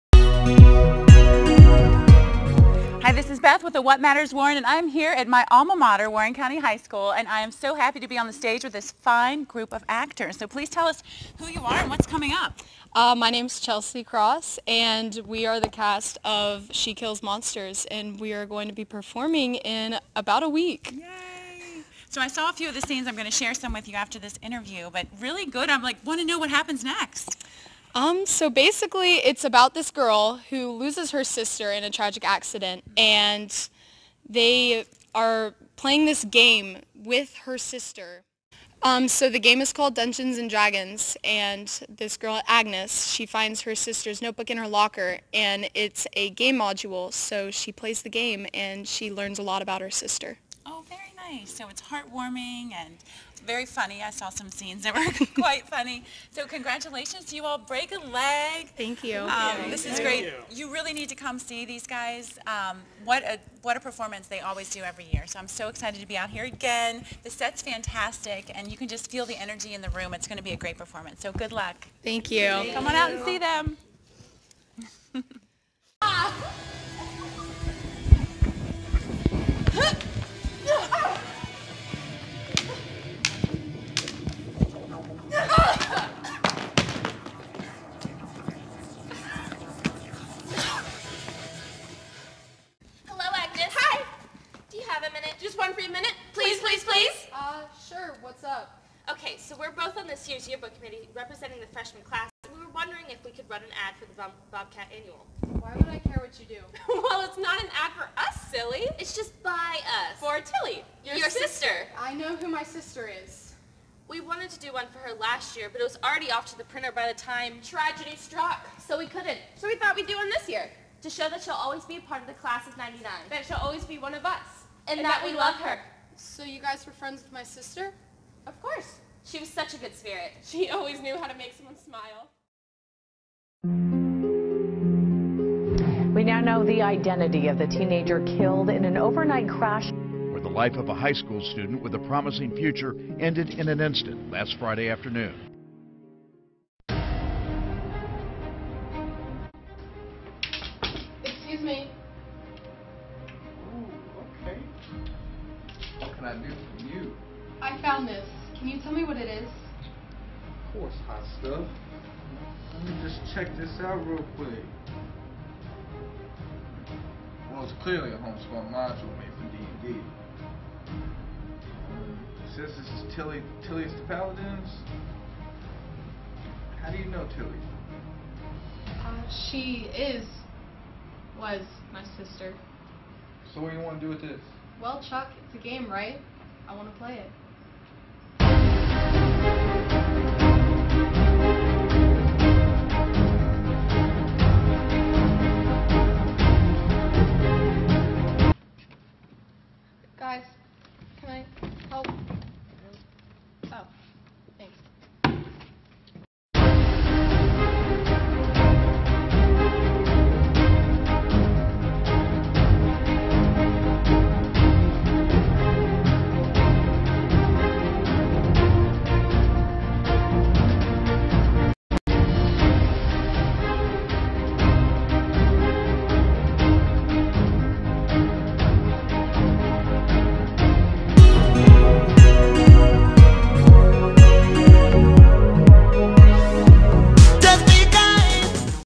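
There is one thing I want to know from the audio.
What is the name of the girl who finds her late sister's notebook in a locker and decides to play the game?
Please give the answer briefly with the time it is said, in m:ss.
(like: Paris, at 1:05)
Agnes, at 0:42.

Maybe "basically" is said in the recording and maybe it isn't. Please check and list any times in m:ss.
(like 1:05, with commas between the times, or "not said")
0:28.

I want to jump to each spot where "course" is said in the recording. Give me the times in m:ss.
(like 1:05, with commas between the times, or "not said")
2:08, 2:40.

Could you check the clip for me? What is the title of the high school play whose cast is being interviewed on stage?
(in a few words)
She Kills Monsters.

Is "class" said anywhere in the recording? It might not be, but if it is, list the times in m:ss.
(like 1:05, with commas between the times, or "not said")
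1:42, 2:02.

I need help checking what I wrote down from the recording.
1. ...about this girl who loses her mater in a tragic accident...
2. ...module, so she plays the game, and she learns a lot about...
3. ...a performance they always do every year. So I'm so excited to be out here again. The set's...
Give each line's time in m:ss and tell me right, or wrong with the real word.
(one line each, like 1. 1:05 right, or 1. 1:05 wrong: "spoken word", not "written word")
1. 0:29 wrong: "sister", not "mater"
2. 0:46 right
3. 1:03 right.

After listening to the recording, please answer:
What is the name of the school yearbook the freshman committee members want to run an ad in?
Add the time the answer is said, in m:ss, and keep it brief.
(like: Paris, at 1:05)
Bobcat Annual, at 1:44.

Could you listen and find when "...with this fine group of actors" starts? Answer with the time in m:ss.
0:08.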